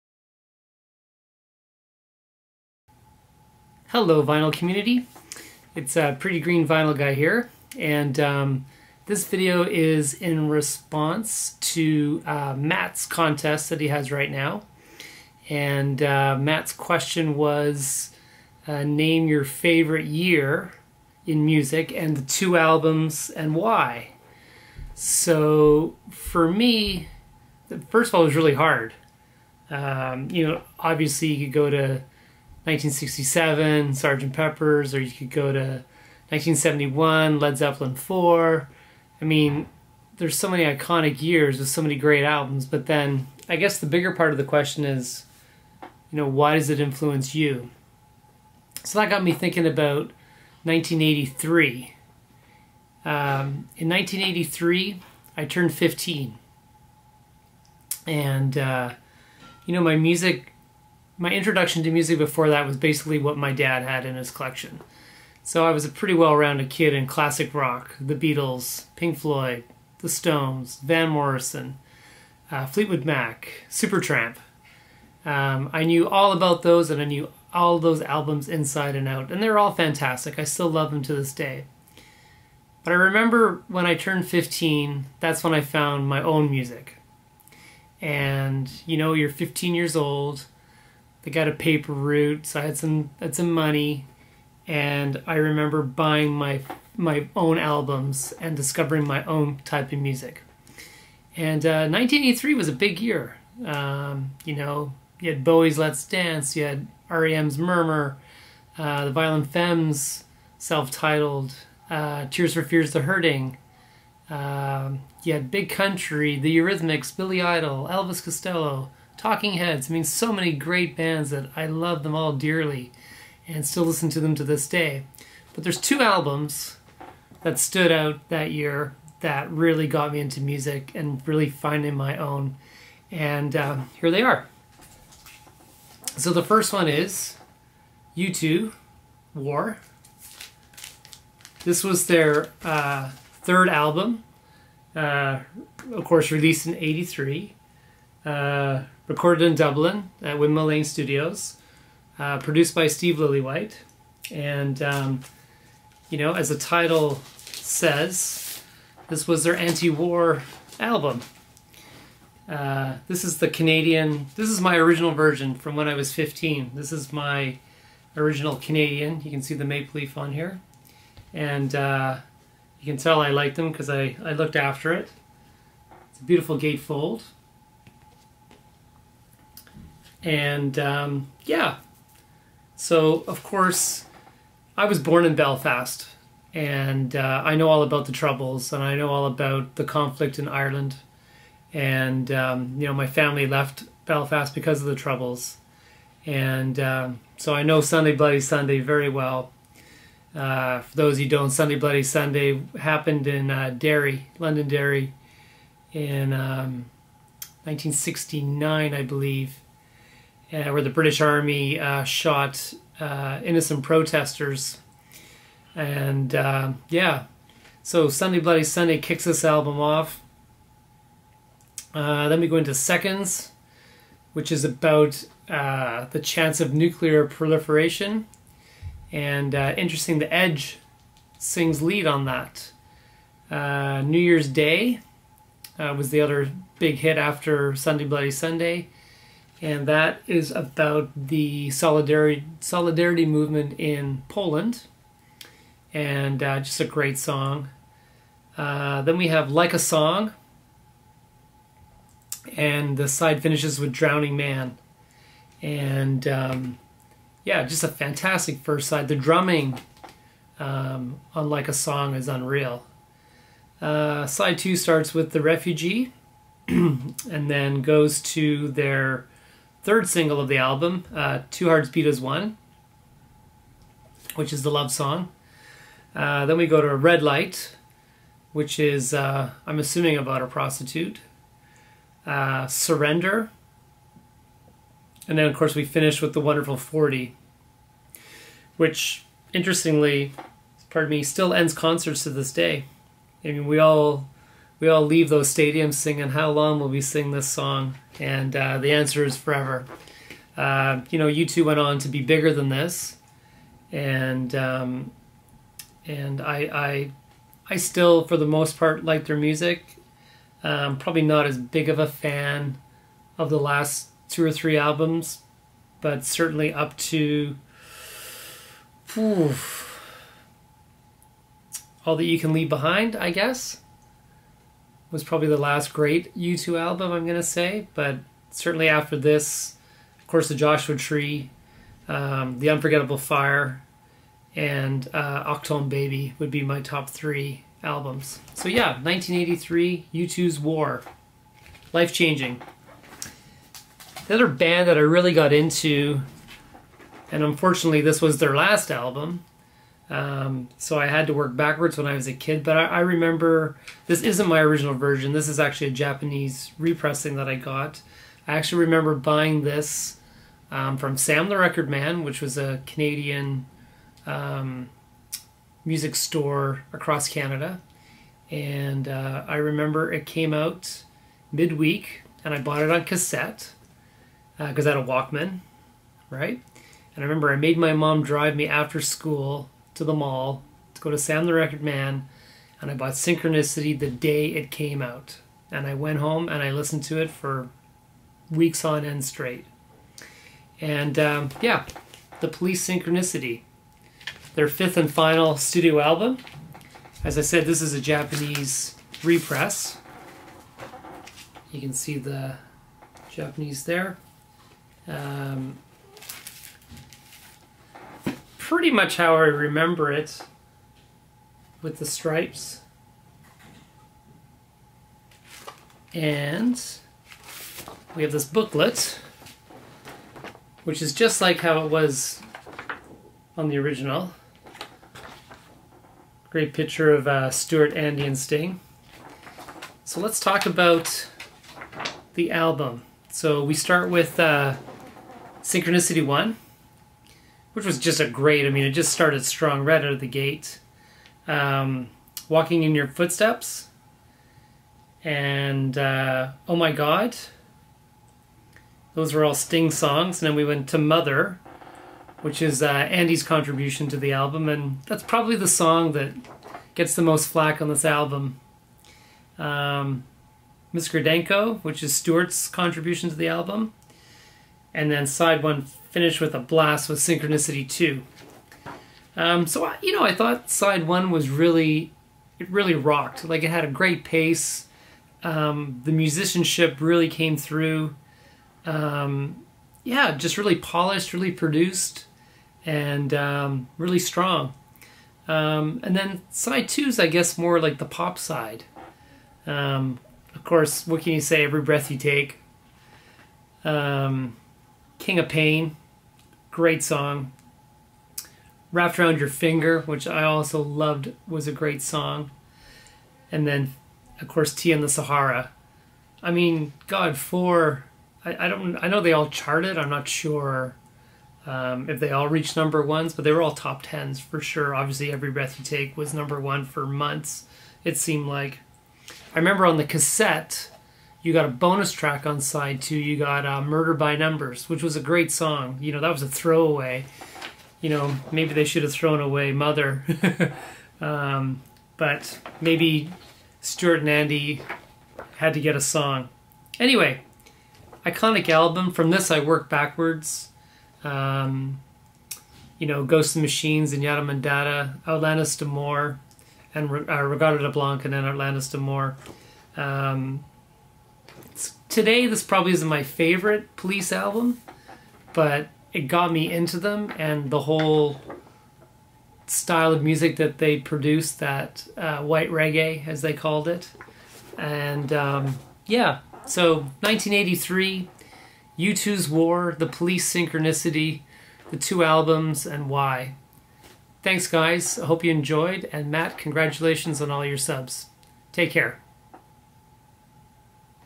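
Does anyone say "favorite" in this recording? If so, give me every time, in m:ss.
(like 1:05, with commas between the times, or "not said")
0:19, 9:13.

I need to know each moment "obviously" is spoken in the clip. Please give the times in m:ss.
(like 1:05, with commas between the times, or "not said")
0:30, 8:34.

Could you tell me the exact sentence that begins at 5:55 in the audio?
This is actually a Japanese repressing that I got.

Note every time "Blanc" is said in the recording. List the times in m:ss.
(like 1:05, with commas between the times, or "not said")
9:07.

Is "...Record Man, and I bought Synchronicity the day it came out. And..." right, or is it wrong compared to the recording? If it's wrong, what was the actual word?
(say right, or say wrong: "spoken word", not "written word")
right.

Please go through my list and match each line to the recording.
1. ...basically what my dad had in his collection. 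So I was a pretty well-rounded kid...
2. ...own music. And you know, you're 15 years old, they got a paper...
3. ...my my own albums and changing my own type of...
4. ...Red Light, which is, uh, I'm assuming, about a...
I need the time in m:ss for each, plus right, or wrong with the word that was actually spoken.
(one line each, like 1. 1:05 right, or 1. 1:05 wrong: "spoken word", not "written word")
1. 1:02 right
2. 1:26 right
3. 1:36 wrong: "discovering", not "changing"
4. 4:36 right.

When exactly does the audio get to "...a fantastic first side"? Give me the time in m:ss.
4:17.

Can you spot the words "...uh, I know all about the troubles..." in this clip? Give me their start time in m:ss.
3:07.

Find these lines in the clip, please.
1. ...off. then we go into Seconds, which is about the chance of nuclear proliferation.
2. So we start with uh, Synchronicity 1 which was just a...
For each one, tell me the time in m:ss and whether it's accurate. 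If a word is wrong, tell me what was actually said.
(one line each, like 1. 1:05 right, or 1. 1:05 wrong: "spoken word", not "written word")
1. 3:39 right
2. 7:13 right.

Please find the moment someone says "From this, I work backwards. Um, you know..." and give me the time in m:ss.
8:59.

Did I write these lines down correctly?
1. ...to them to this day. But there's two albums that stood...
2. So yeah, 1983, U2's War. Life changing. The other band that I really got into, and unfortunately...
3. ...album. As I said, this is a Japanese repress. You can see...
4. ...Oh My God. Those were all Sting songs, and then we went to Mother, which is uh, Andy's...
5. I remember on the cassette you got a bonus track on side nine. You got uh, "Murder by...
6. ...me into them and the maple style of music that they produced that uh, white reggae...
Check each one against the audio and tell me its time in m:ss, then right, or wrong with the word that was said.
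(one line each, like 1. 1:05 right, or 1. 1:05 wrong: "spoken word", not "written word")
1. 2:04 right
2. 5:38 right
3. 6:35 right
4. 7:26 right
5. 8:39 wrong: "two", not "nine"
6. 9:16 wrong: "whole", not "maple".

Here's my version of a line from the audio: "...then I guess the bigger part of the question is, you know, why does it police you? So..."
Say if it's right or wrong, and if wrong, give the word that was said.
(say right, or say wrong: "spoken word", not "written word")
wrong: "influence", not "police".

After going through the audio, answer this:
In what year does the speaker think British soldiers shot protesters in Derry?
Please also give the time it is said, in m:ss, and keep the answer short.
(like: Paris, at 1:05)
1969, at 3:27.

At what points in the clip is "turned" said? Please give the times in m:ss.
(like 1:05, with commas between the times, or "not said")
0:55, 1:23.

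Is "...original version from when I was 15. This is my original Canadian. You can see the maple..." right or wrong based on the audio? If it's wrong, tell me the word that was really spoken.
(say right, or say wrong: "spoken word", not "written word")
right.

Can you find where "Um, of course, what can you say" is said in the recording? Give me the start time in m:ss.
8:09.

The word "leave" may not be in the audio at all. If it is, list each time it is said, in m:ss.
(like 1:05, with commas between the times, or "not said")
4:55, 5:22.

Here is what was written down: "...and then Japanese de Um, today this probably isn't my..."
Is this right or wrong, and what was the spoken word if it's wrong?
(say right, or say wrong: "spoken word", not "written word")
wrong: "Outlandish", not "Japanese".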